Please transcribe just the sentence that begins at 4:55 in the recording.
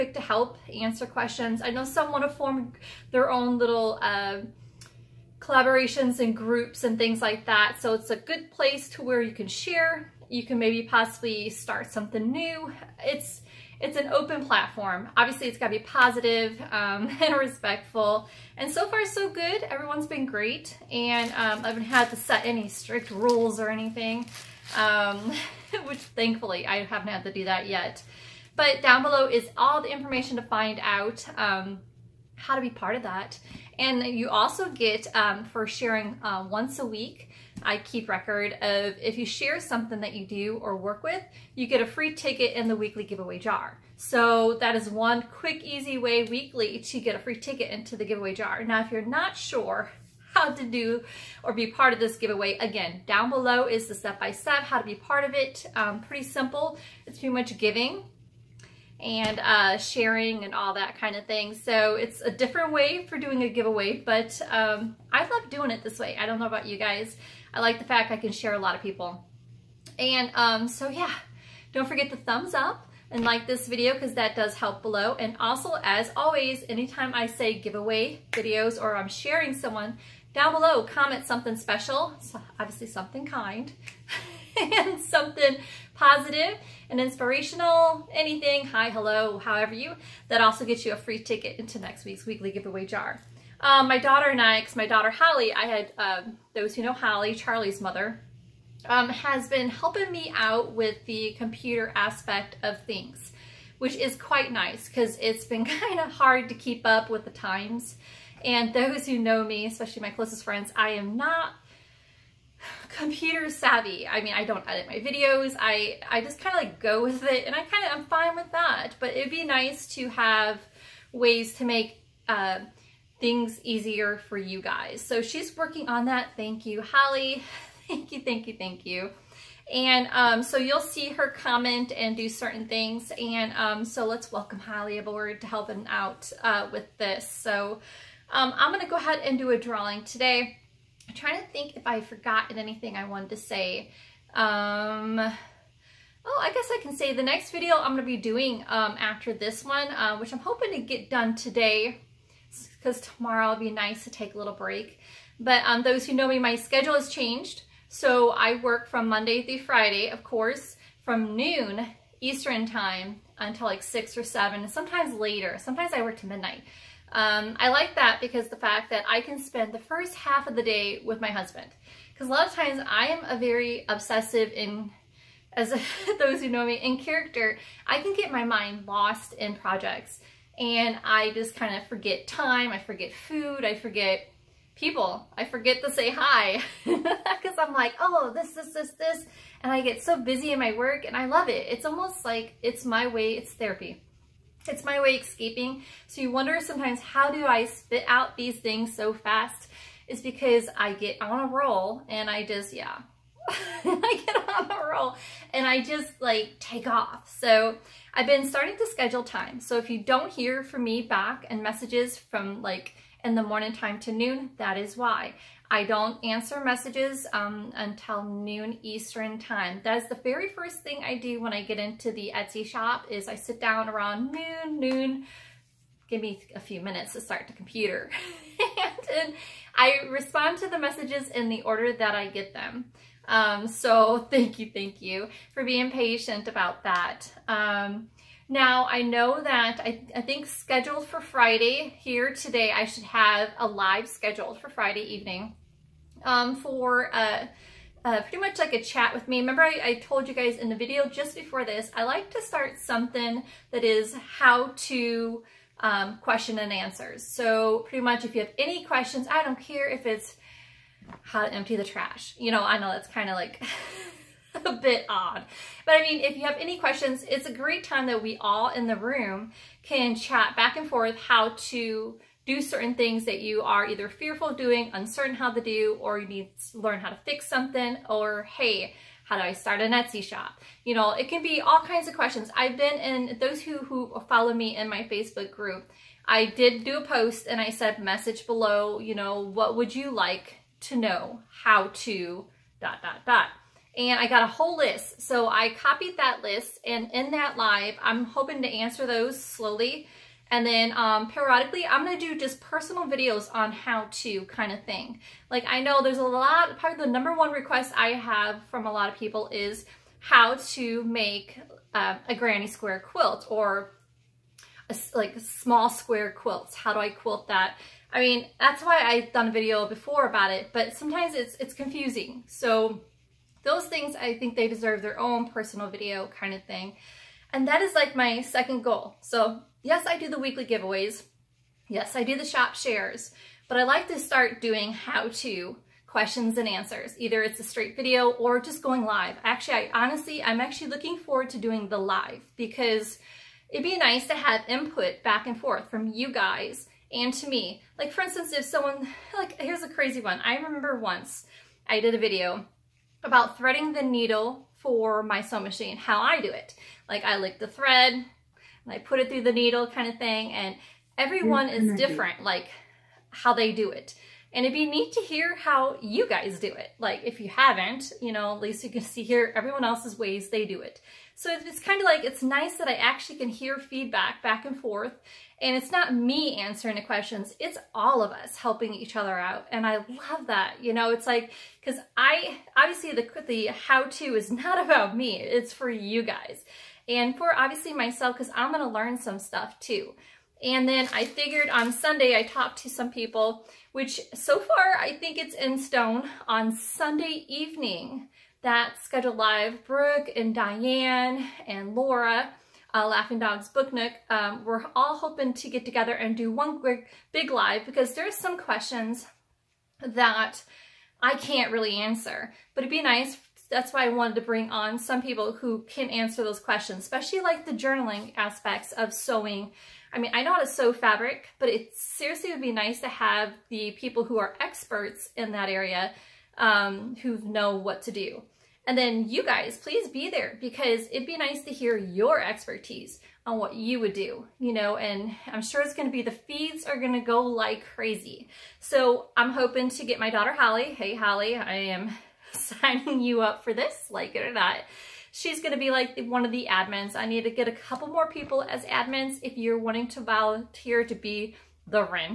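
So I copied that list and in that live, I'm hoping to answer those slowly.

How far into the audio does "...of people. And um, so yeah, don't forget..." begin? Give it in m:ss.
1:08.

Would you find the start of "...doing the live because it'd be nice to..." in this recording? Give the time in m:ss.
5:41.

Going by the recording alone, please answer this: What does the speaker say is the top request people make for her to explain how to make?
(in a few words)
granny square quilt.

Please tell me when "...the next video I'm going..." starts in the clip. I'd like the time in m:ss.
2:27.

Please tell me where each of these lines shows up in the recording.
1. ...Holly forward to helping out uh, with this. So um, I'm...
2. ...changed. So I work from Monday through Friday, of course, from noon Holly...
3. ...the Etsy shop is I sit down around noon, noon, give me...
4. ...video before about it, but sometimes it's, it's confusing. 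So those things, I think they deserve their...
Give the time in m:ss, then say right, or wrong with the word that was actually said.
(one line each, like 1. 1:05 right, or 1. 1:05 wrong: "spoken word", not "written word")
1. 2:14 wrong: "aboard", not "forward"
2. 2:37 wrong: "Eastern", not "Holly"
3. 3:42 right
4. 5:19 right.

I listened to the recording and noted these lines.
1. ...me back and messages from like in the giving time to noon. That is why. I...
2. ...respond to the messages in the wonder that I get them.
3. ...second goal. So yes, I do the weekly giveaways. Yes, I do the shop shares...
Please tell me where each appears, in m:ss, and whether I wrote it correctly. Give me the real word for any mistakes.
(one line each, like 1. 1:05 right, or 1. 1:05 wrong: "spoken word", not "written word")
1. 3:30 wrong: "morning", not "giving"
2. 3:50 wrong: "order", not "wonder"
3. 5:28 right.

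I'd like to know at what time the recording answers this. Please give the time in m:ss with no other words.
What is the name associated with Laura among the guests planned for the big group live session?
6:43.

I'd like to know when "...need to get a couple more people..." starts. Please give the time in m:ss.
7:27.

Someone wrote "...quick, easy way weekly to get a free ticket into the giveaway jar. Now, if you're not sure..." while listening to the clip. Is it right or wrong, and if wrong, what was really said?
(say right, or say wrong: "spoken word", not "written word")
right.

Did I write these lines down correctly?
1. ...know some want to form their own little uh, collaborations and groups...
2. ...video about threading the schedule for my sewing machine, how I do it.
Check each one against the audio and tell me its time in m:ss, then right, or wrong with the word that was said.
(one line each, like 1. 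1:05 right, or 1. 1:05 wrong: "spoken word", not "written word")
1. 0:01 right
2. 5:52 wrong: "needle", not "schedule".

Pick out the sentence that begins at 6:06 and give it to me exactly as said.
Like if you haven't, you know, at least you can see here everyone else's ways they do it.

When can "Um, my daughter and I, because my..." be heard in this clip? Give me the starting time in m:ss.
1:33.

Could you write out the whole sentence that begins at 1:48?
And those who know me, especially my closest friends, I am not computer savvy.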